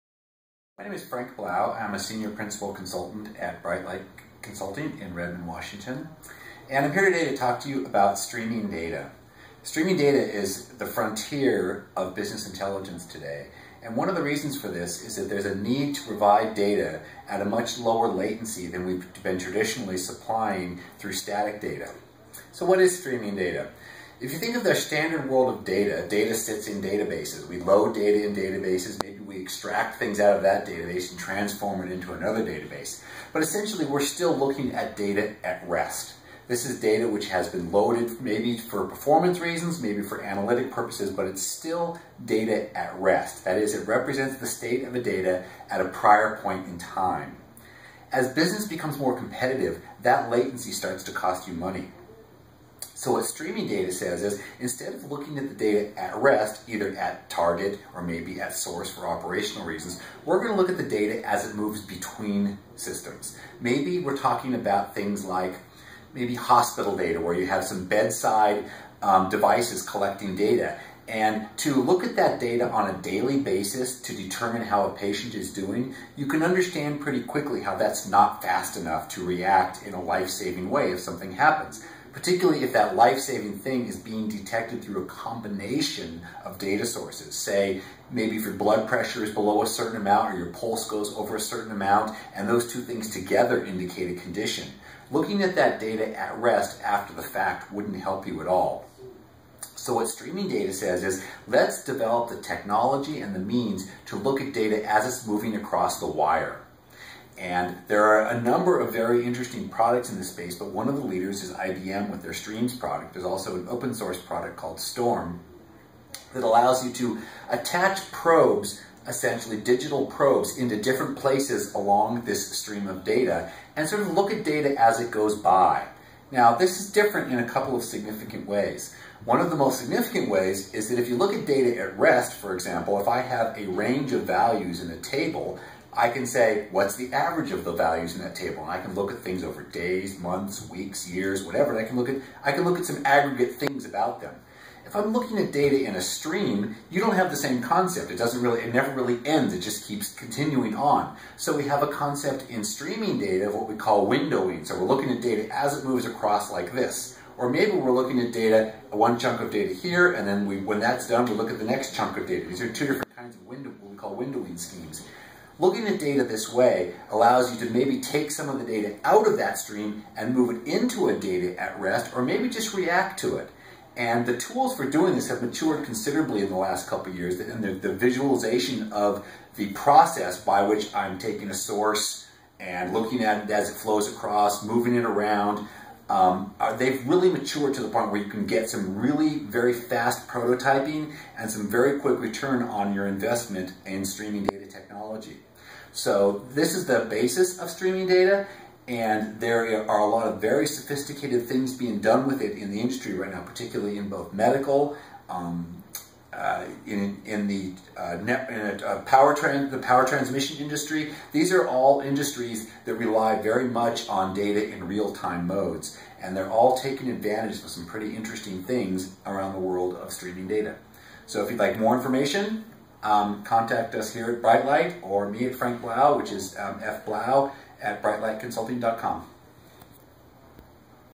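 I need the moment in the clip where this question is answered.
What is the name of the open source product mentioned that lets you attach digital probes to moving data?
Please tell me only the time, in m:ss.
1:54.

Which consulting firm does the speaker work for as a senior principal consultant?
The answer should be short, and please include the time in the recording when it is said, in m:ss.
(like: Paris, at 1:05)
Brightlight Consulting, at 0:03.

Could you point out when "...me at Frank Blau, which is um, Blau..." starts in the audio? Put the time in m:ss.
3:45.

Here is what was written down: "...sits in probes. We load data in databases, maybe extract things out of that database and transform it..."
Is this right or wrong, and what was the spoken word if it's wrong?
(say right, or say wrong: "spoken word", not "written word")
wrong: "databases", not "probes".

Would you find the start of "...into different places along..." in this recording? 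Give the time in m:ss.
2:00.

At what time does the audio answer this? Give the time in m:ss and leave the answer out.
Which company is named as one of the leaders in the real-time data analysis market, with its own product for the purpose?
1:51.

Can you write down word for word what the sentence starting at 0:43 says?
That is, it represents the state of a data at a prior point in time.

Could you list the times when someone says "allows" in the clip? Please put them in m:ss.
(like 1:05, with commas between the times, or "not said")
1:56, 2:47.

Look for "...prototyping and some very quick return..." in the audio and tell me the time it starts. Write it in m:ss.
3:10.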